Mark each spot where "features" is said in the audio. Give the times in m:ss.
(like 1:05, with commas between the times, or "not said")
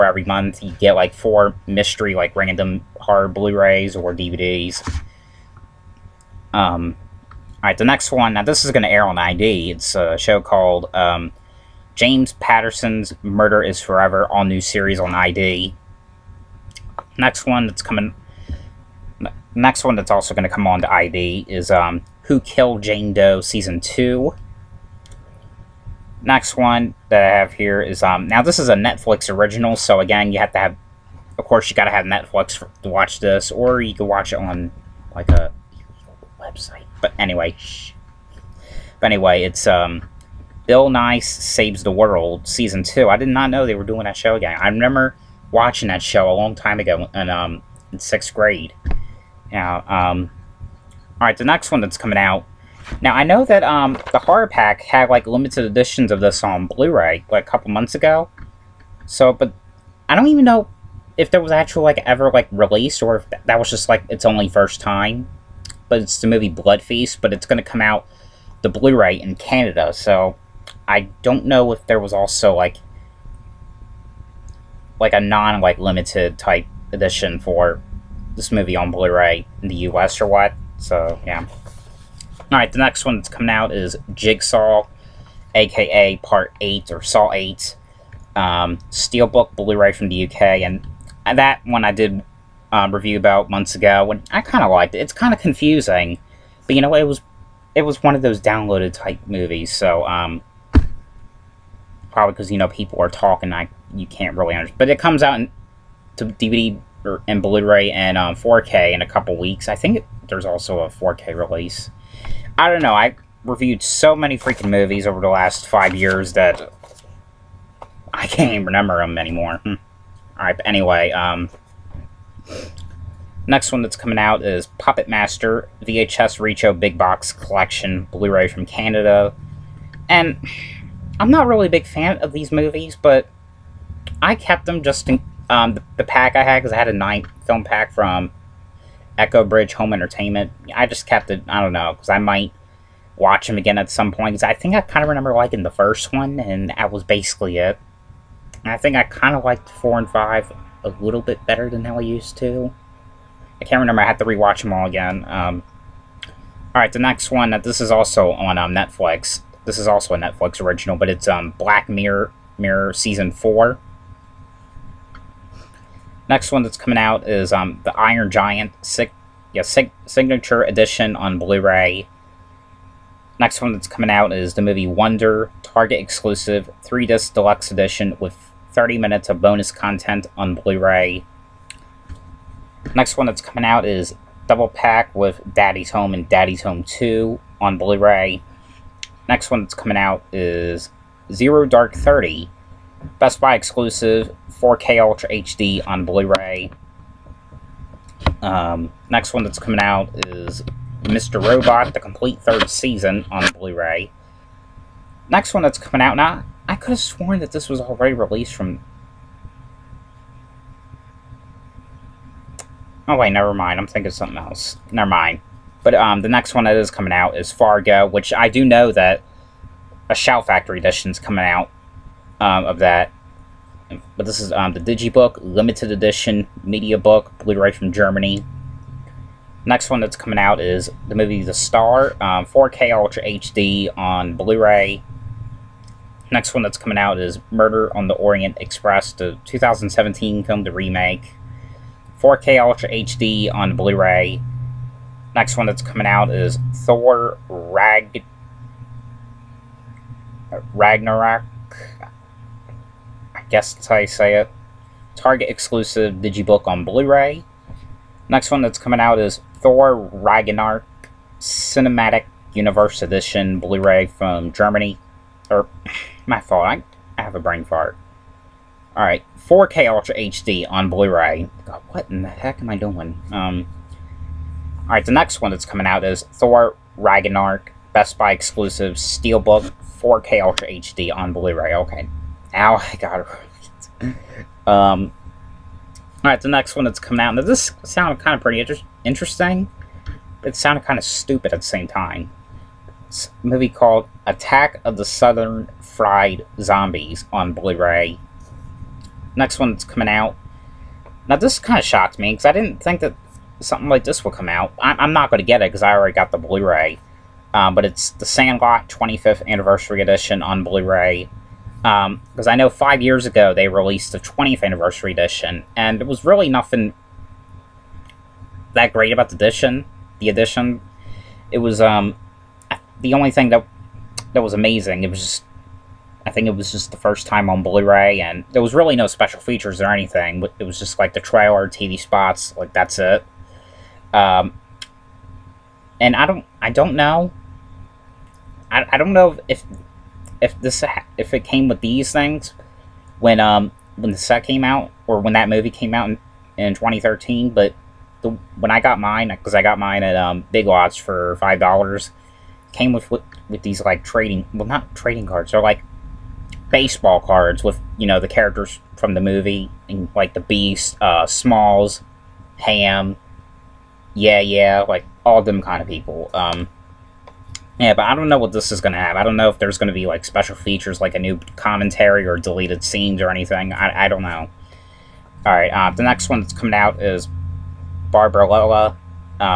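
5:29, 6:10.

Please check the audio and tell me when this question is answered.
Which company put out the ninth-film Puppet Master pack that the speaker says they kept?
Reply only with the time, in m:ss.
2:19.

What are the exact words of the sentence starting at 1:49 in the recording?
I think there's also a 4K release.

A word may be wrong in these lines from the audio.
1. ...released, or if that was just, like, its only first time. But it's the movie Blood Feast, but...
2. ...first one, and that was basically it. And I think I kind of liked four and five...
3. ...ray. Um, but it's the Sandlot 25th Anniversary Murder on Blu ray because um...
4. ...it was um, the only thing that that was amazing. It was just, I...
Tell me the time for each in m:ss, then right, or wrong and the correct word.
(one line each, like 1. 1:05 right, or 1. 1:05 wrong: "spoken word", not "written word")
1. 1:02 right
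2. 2:25 right
3. 5:06 wrong: "Edition", not "Murder"
4. 5:21 right.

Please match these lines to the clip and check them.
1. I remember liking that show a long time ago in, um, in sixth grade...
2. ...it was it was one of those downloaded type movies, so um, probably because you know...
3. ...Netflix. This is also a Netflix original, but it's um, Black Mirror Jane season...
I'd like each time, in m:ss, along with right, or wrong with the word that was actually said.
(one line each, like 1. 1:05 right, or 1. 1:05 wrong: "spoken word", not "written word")
1. 0:44 wrong: "watching", not "liking"
2. 1:36 right
3. 2:38 wrong: "Mirror", not "Jane".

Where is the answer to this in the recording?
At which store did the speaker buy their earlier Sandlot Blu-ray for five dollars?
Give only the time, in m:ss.
5:50.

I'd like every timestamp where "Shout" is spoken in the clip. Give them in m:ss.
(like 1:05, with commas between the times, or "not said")
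3:40.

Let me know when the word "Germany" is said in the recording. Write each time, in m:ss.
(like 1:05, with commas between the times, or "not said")
3:47, 4:24.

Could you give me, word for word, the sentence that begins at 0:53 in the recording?
Now, I know that, um, the horror pack had, like, limited editions of this on Blu-ray, like, a couple months ago.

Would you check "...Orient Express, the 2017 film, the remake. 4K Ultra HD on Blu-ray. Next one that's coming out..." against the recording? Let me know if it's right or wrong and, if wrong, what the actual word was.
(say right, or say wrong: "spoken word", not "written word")
right.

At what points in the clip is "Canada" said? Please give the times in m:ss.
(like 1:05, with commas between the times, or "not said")
1:09, 2:08.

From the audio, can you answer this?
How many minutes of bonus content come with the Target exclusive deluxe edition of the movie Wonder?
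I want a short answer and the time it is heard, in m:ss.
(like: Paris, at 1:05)
30, at 2:58.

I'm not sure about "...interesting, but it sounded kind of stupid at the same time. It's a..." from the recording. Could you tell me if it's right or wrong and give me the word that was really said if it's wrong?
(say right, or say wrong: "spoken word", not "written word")
right.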